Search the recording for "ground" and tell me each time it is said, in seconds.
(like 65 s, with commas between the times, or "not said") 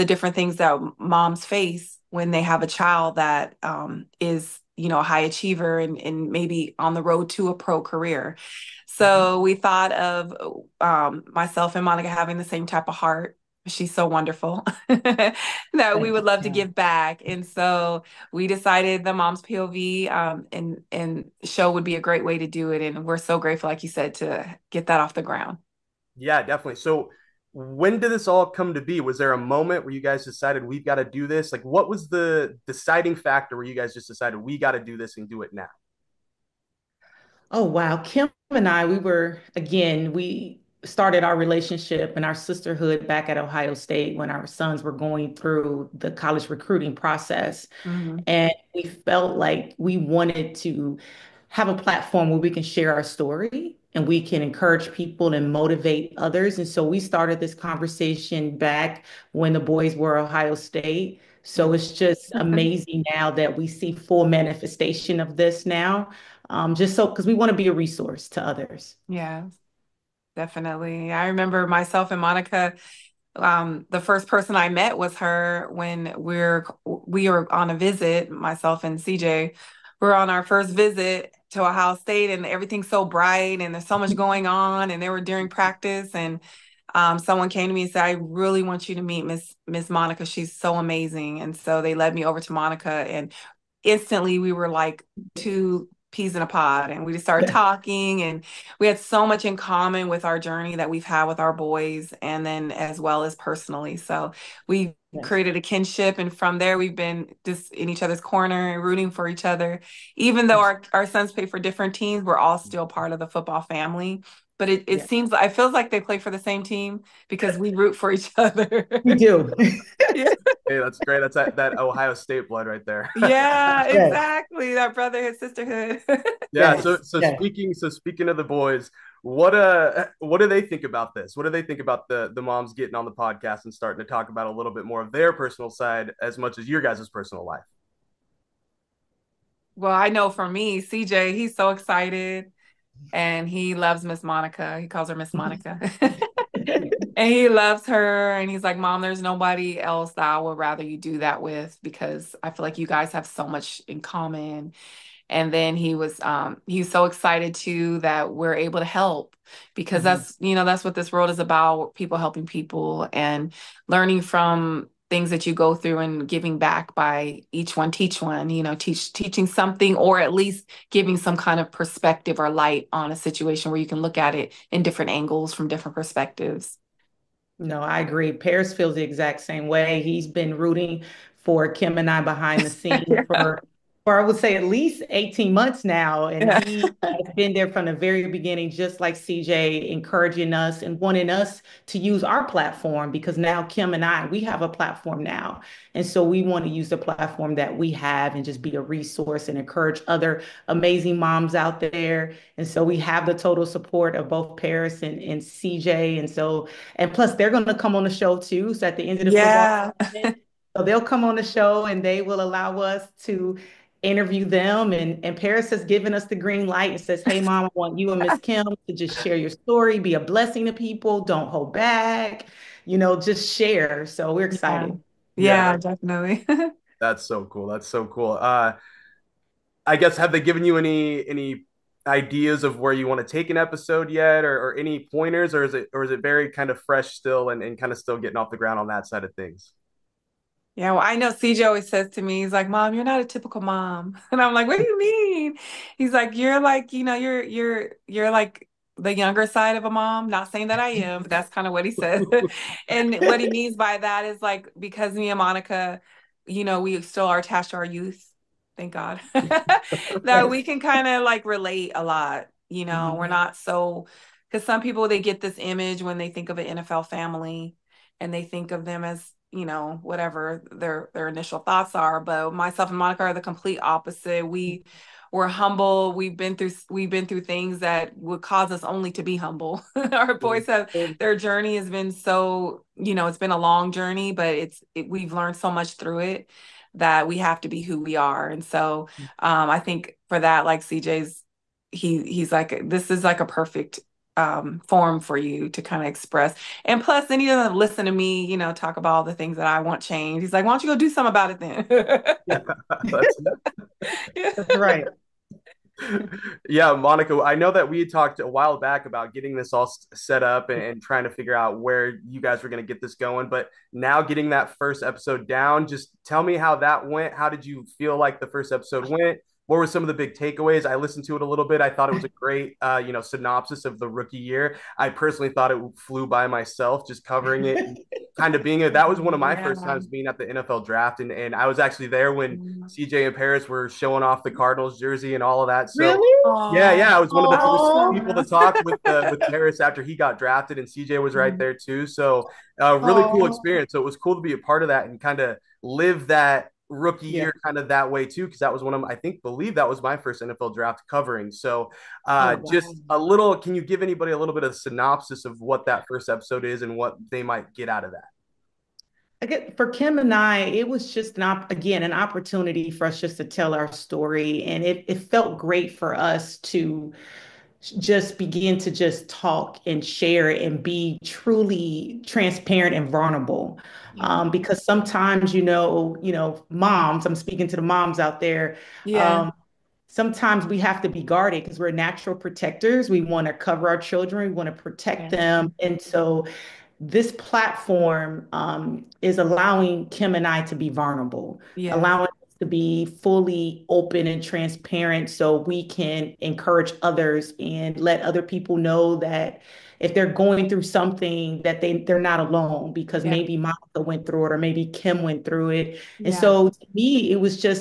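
25 s, 238 s.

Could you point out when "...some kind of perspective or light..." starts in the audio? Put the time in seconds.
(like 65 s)
171 s.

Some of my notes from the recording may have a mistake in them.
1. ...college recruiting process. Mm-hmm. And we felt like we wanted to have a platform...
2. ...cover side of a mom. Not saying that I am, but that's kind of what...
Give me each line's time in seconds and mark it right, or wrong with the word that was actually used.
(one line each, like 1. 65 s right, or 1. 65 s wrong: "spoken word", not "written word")
1. 46 s right
2. 249 s wrong: "younger", not "cover".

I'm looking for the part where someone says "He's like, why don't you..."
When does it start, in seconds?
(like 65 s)
300 s.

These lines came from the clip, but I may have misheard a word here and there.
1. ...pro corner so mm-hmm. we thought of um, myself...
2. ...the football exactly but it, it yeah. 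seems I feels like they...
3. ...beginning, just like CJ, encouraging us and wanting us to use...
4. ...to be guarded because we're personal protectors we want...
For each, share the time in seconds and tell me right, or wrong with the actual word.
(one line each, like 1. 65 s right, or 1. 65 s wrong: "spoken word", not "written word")
1. 7 s wrong: "career", not "corner"
2. 113 s wrong: "family", not "exactly"
3. 188 s right
4. 381 s wrong: "natural", not "personal".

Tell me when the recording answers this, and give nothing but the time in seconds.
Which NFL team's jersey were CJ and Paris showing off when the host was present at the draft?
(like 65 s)
334 s.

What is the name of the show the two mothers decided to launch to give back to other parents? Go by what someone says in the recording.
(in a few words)
The Mom's POV.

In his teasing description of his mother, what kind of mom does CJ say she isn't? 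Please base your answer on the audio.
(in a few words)
a typical mom.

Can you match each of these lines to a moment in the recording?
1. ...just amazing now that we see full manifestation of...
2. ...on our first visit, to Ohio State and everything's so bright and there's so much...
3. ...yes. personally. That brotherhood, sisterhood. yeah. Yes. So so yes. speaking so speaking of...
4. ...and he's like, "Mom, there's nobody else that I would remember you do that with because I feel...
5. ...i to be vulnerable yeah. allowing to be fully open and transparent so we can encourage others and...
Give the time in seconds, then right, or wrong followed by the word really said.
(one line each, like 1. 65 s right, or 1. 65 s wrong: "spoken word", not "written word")
1. 61 s right
2. 80 s right
3. 123 s wrong: "exactly", not "personally"
4. 148 s wrong: "rather", not "remember"
5. 390 s right.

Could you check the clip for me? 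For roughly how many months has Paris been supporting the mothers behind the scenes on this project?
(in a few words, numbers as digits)
18.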